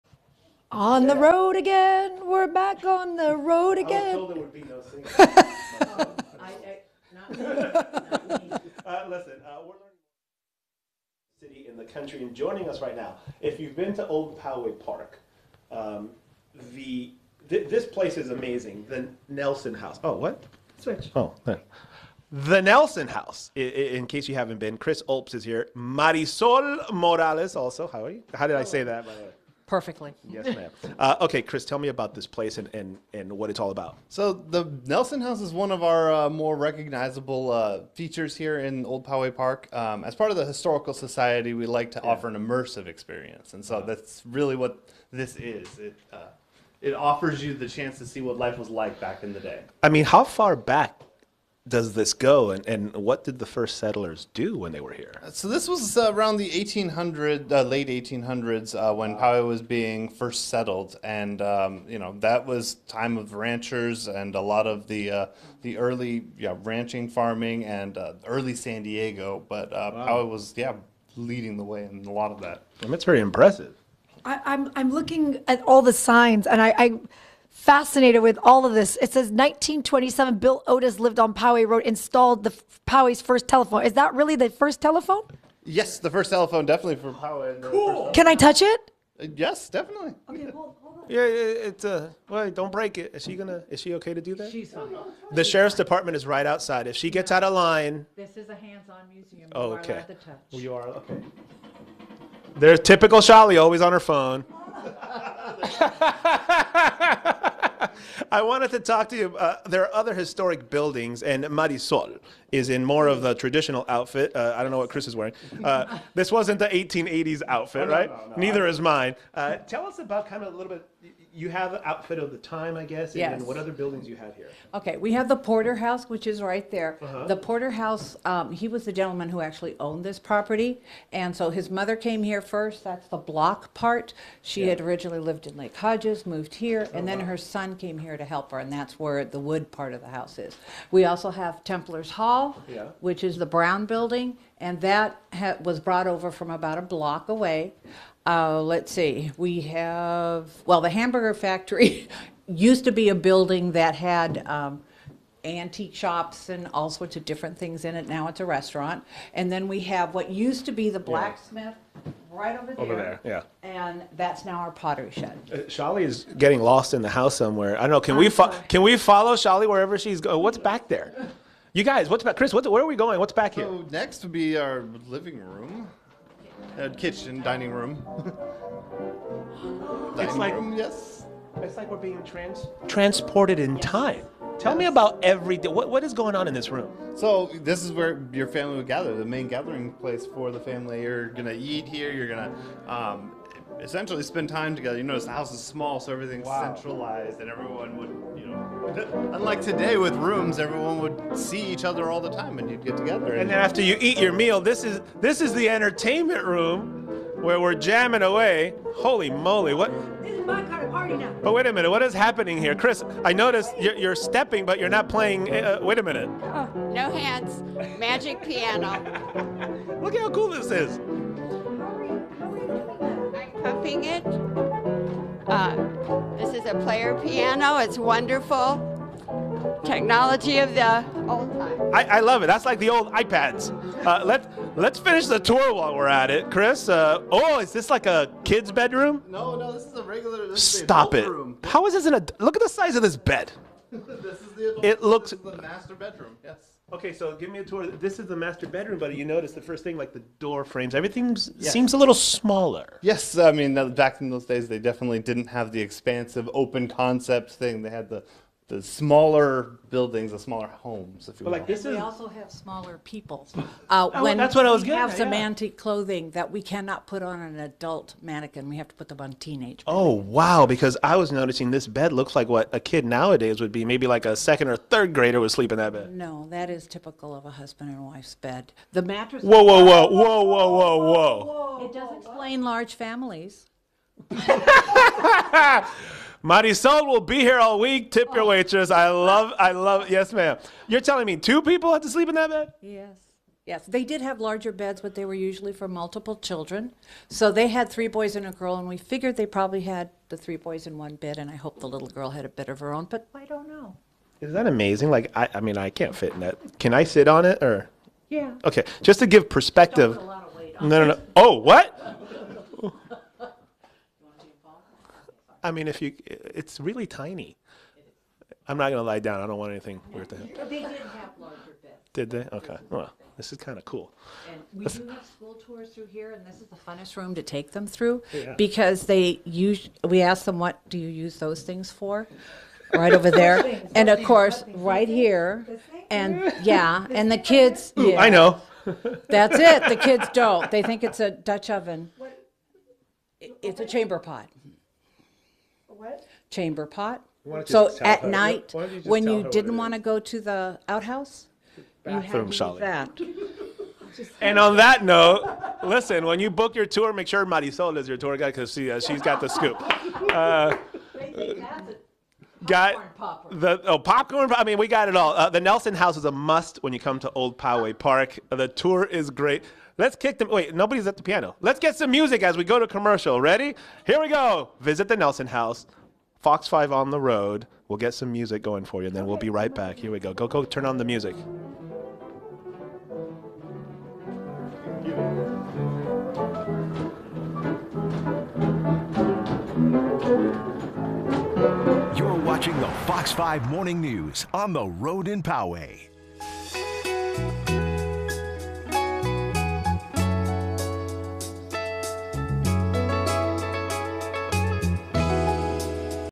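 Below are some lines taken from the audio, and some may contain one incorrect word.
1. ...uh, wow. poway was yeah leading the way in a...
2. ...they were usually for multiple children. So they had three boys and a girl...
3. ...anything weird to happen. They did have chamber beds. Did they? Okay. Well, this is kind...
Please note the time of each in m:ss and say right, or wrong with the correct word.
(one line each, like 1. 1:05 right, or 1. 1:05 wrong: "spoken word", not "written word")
1. 1:09 right
2. 4:55 right
3. 5:19 wrong: "larger", not "chamber".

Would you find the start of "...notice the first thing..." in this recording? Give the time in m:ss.
4:09.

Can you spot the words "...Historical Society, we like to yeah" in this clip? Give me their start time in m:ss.
0:40.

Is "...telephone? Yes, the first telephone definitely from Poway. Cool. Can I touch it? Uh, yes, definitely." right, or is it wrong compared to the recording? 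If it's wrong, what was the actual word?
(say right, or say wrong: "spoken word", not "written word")
right.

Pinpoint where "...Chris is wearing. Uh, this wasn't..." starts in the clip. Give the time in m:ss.
1:54.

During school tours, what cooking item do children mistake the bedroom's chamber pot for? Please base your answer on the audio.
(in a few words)
A Dutch oven.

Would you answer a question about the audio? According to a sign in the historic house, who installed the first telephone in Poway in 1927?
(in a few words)
Bill Otis.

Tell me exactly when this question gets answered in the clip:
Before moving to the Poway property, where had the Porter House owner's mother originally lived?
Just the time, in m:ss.
2:15.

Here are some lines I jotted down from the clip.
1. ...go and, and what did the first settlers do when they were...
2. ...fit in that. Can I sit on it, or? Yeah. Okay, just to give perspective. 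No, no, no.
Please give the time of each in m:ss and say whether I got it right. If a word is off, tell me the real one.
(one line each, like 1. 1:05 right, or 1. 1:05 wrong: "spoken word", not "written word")
1. 0:52 right
2. 5:06 right.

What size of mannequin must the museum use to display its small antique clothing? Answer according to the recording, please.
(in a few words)
Teenage.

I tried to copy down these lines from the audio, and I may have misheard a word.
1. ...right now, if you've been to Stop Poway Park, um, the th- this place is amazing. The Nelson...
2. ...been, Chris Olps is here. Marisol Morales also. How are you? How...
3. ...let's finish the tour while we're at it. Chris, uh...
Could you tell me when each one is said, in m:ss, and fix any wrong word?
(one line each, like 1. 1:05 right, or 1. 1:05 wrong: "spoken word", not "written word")
1. 0:12 wrong: "Old", not "Stop"
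2. 0:24 right
3. 3:54 right.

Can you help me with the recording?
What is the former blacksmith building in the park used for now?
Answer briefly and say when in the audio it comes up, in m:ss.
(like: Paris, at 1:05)
Pottery shed, at 2:44.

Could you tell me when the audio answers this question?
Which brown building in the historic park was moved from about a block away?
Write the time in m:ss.
2:21.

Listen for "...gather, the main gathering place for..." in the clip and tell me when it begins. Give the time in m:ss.
3:08.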